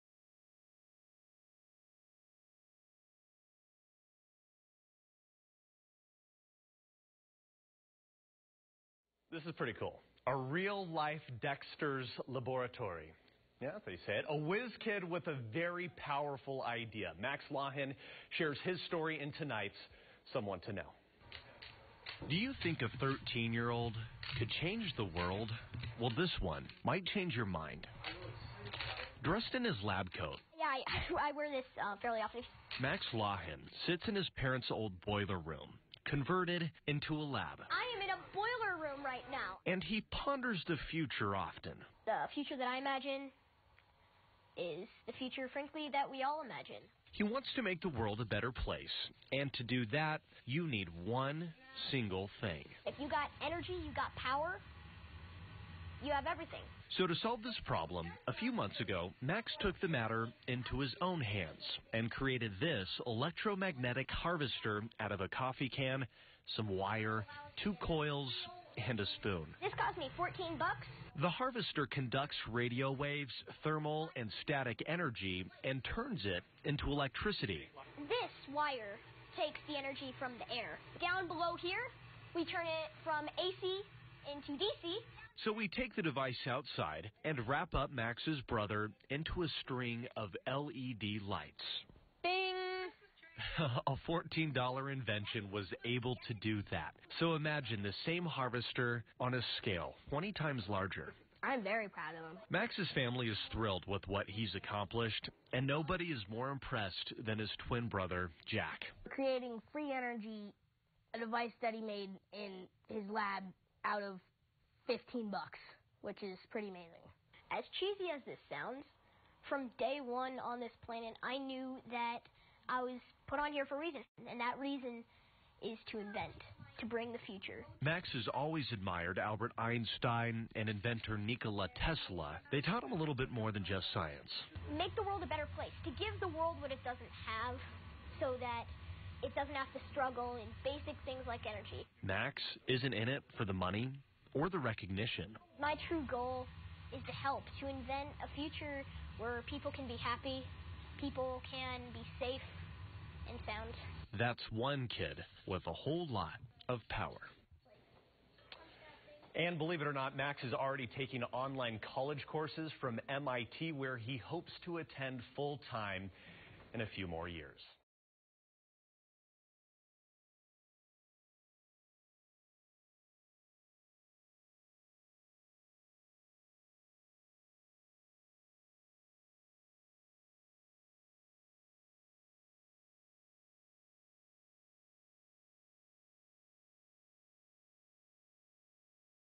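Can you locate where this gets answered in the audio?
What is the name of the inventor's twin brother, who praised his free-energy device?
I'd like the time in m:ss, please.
1:48.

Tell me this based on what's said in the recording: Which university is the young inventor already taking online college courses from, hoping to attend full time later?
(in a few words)
MIT.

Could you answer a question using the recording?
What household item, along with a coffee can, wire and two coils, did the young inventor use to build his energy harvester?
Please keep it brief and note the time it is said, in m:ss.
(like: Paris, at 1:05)
a spoon, at 1:08.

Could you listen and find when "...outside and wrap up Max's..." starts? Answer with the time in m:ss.
1:26.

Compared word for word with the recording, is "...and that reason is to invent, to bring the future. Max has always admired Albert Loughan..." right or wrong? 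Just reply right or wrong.
wrong.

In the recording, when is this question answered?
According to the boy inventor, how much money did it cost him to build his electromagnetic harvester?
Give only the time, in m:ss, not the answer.
1:10.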